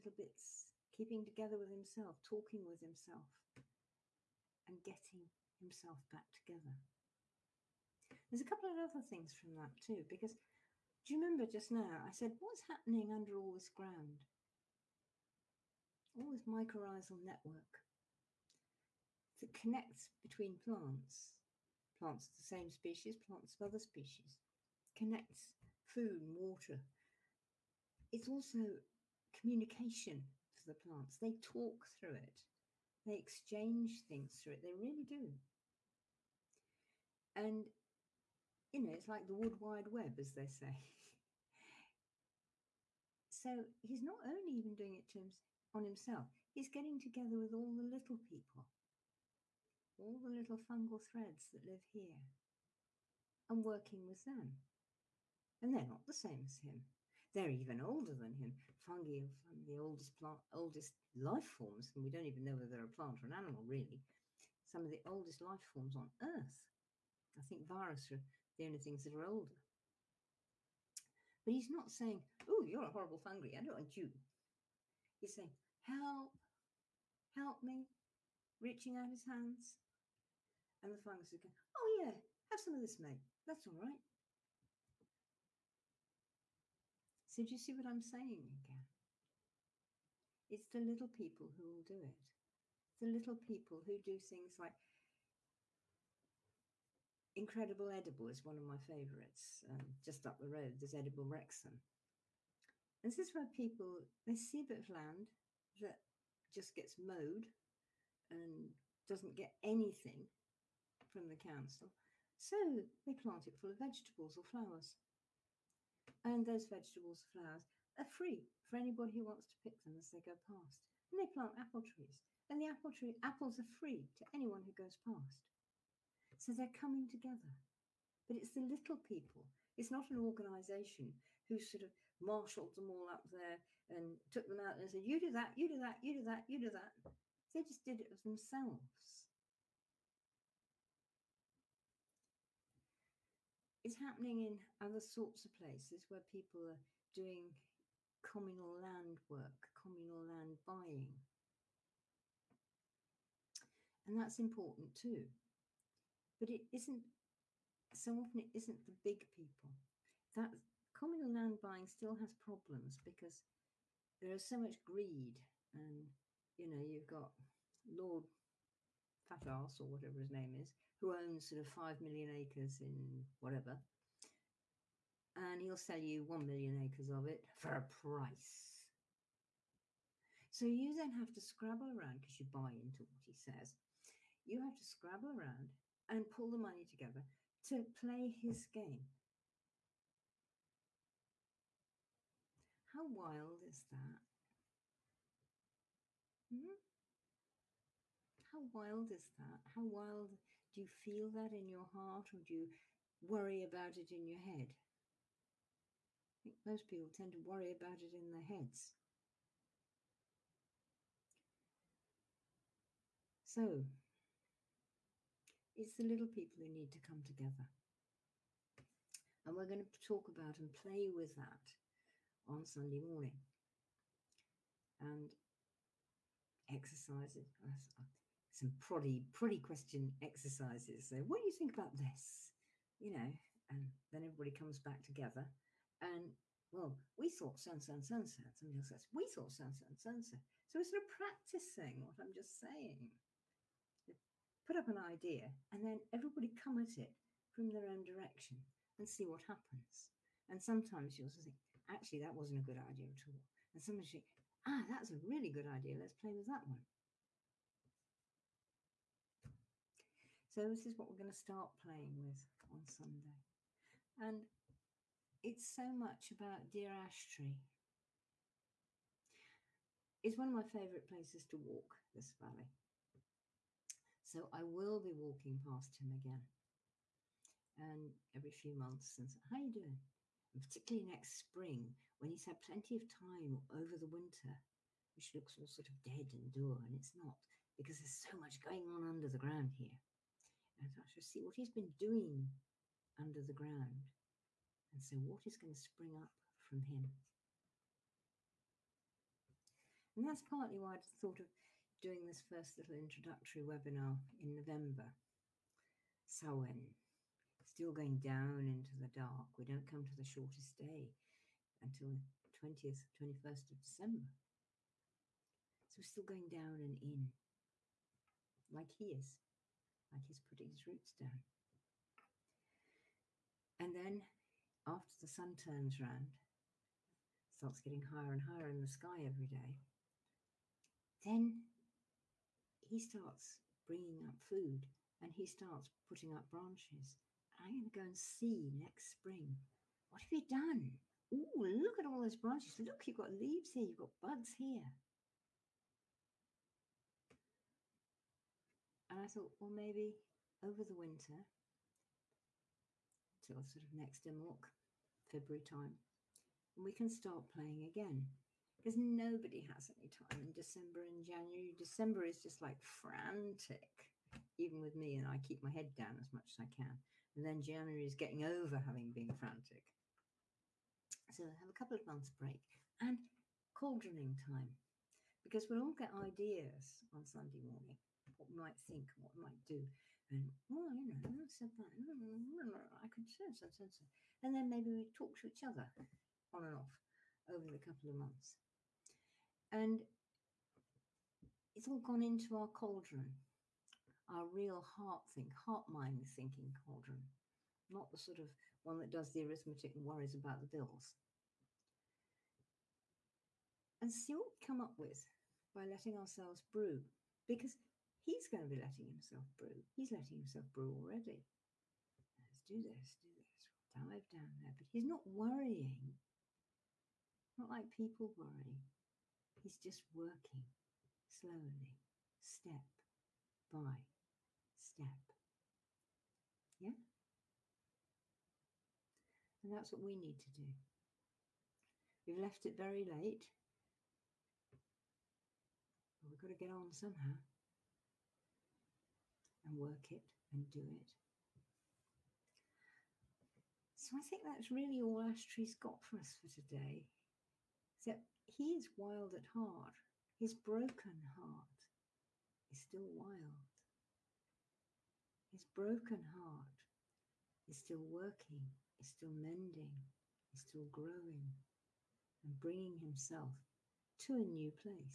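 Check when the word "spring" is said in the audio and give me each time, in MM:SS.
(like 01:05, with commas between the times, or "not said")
04:41, 04:55, 05:39.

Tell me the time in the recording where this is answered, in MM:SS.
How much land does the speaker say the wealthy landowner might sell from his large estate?
02:56.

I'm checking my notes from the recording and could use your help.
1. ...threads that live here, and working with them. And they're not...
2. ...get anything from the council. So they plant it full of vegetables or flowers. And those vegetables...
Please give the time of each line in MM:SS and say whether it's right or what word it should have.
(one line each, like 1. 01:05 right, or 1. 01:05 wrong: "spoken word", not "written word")
1. 00:51 right
2. 01:49 right.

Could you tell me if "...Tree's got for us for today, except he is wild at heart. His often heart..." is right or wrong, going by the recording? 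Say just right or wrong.
wrong.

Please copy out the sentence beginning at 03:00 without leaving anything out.
So you then have to scrabble around because you buy into what he says.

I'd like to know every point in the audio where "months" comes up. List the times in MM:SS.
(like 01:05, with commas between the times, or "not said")
04:38, 06:12, 06:28.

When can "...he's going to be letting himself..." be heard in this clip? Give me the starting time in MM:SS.
06:48.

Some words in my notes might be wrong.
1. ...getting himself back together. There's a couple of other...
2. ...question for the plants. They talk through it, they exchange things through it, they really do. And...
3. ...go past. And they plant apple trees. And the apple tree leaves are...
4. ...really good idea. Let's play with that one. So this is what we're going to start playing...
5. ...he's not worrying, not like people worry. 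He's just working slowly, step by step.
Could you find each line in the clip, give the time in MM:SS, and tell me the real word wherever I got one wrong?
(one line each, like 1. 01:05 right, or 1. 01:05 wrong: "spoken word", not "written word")
1. 00:04 right
2. 00:29 wrong: "communication", not "question"
3. 02:00 wrong: "apples", not "leaves"
4. 04:15 right
5. 06:54 right.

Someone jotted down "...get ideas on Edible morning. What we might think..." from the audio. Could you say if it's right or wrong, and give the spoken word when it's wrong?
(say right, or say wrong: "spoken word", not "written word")
wrong: "Sunday", not "Edible".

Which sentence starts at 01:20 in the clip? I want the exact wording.
And the fungus is going, Oh, yeah, have some of this, mate.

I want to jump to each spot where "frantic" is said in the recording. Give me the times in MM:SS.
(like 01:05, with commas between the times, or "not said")
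06:02, 06:09.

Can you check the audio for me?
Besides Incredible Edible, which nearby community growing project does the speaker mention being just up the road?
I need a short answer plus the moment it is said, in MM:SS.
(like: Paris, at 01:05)
Edible Wrexham, at 01:40.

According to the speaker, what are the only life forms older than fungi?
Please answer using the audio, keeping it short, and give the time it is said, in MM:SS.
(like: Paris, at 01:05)
viruses, at 01:07.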